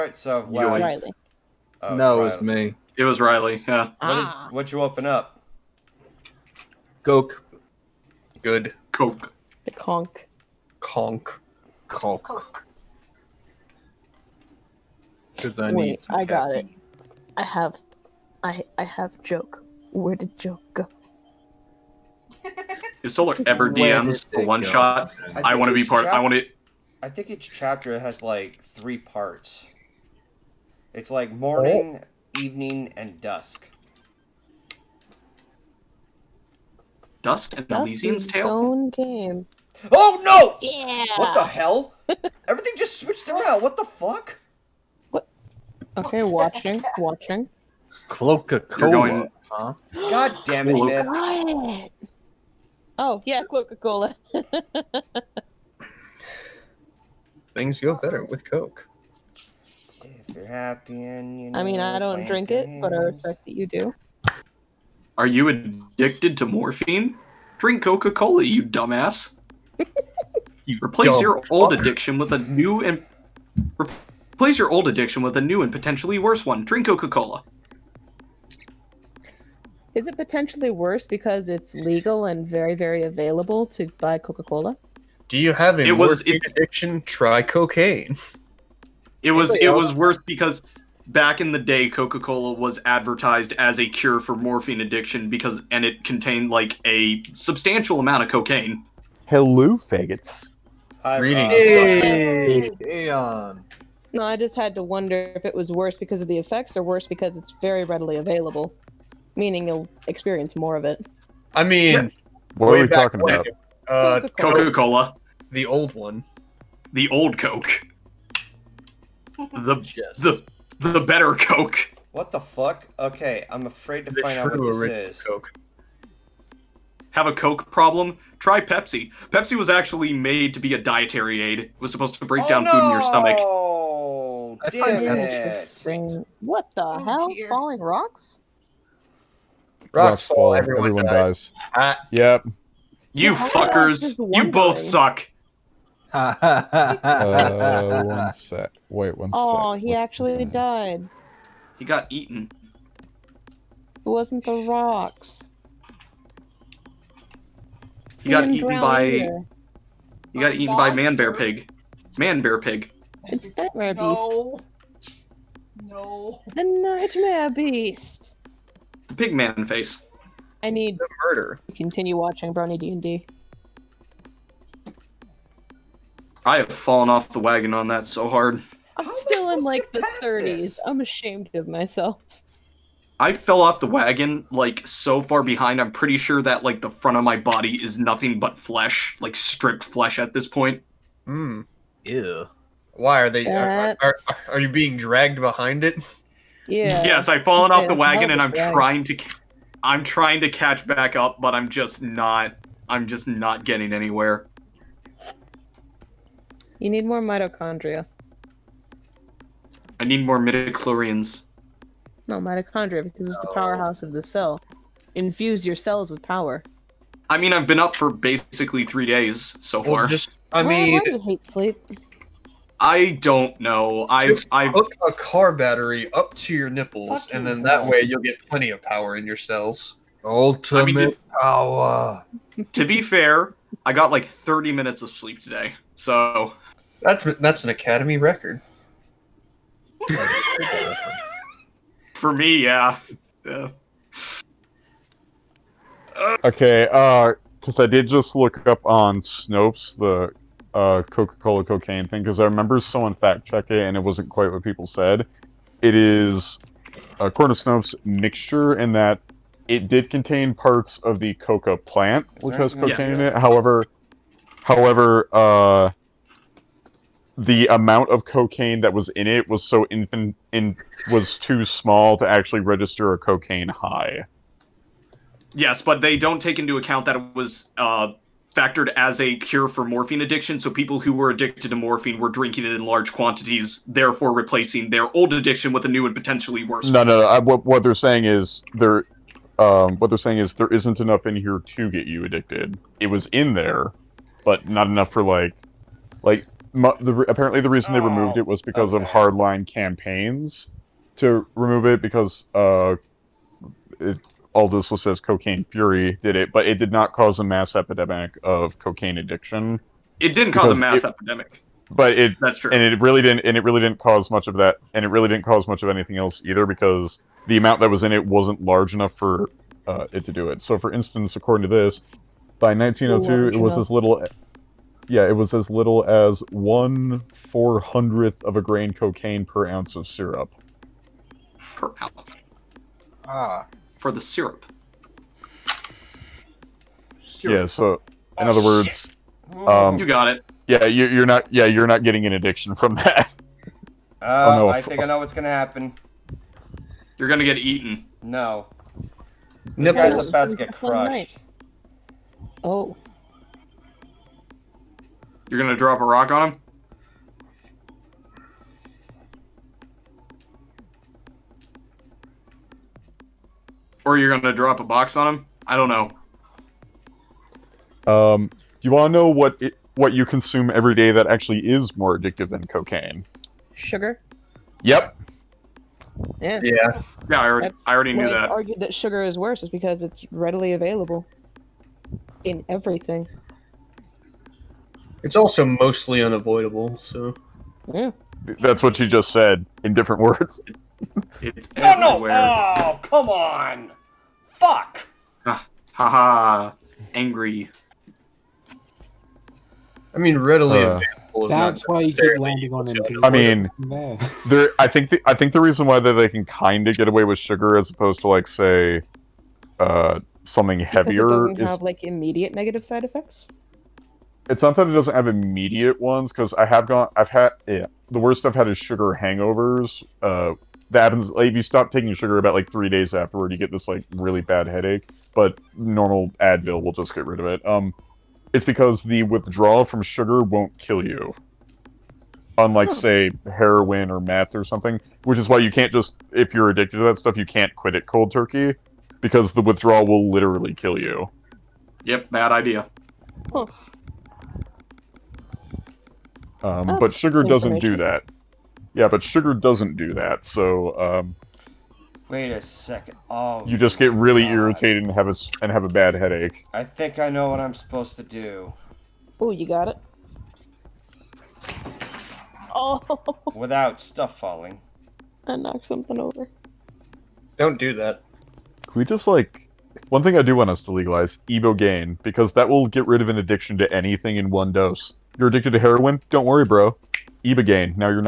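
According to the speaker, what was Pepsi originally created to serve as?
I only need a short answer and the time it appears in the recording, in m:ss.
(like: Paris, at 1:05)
a dietary aid, at 2:10.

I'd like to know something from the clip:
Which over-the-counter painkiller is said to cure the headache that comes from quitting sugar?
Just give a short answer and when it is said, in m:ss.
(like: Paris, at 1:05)
Advil, at 7:06.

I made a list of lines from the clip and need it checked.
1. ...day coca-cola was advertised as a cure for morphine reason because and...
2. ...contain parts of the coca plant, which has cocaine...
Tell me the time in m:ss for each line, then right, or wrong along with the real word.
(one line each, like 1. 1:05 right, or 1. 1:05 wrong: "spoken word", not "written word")
1. 1:31 wrong: "addiction", not "reason"
2. 4:20 right.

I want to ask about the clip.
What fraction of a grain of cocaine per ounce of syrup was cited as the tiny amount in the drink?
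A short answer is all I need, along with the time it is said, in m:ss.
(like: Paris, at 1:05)
one four hundredth, at 5:26.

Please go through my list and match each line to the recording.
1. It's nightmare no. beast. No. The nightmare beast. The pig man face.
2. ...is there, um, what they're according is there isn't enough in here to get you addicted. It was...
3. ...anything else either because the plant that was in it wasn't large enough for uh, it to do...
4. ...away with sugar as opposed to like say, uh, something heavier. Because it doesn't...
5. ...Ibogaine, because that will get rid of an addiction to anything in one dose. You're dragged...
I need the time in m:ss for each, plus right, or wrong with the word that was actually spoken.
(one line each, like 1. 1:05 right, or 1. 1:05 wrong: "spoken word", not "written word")
1. 2:43 right
2. 4:48 wrong: "saying", not "according"
3. 5:15 wrong: "amount", not "plant"
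4. 6:47 right
5. 7:51 wrong: "addicted", not "dragged".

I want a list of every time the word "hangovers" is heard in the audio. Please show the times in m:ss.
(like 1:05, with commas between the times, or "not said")
6:59.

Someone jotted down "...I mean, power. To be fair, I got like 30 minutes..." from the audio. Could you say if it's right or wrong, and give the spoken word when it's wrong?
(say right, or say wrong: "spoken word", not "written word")
right.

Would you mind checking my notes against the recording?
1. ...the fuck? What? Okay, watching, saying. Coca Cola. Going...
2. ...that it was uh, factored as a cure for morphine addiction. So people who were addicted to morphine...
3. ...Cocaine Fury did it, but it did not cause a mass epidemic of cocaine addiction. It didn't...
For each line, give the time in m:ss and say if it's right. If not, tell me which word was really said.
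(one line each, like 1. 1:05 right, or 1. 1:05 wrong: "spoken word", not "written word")
1. 0:43 wrong: "watching", not "saying"
2. 4:37 right
3. 5:05 right.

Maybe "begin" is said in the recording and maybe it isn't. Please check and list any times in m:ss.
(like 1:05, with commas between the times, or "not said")
not said.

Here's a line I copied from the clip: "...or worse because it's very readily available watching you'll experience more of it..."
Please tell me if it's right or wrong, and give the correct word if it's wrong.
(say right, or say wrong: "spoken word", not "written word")
wrong: "meaning", not "watching".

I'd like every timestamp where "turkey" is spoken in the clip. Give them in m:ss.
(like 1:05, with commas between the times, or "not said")
7:18.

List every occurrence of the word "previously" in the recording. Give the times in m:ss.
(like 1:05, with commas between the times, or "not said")
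not said.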